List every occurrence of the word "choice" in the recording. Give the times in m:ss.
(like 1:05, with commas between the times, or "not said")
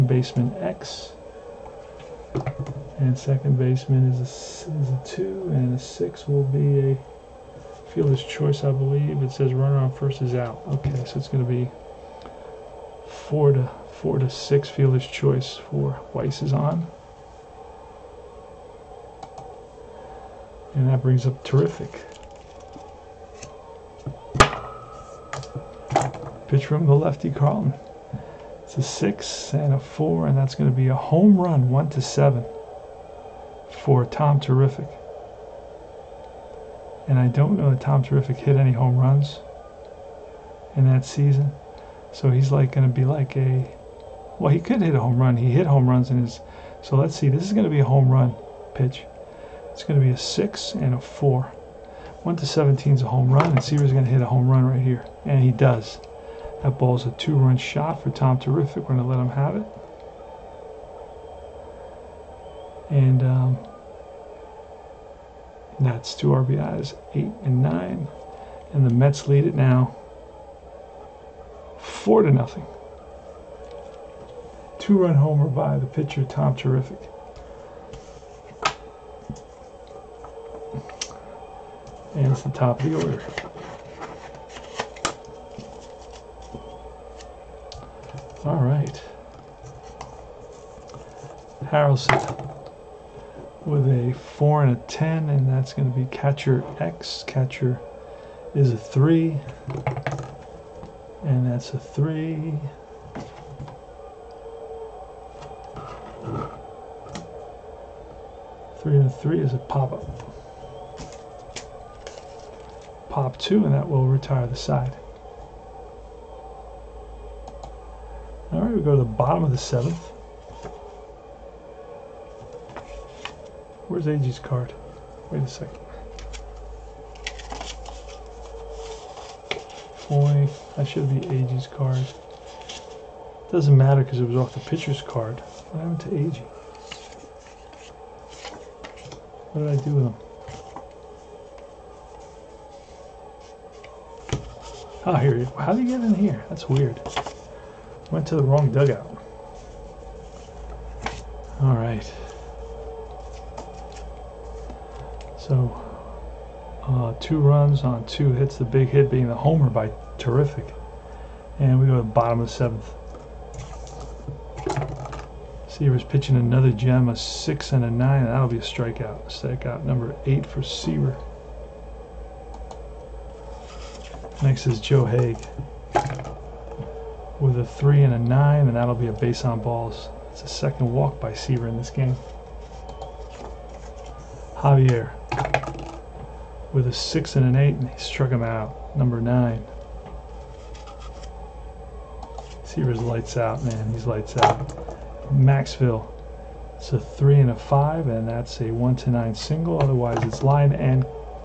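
0:08, 0:15.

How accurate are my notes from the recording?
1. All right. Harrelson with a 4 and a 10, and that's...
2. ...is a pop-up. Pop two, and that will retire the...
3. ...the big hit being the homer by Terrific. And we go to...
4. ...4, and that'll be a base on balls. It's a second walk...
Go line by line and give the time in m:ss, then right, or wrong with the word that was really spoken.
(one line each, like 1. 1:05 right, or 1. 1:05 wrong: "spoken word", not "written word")
1. 1:28 right
2. 1:49 right
3. 2:38 right
4. 2:58 wrong: "9", not "4".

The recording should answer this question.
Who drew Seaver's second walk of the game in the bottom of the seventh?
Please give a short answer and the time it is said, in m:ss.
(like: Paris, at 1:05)
Joe Hague, at 2:54.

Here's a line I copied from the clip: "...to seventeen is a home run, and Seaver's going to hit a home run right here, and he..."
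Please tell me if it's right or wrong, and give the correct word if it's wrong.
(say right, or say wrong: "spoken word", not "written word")
right.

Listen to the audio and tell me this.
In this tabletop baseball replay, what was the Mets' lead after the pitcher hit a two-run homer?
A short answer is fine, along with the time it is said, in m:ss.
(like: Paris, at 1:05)
4 to 0, at 1:11.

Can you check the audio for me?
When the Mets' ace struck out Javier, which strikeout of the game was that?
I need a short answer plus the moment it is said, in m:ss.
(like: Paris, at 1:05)
9, at 3:08.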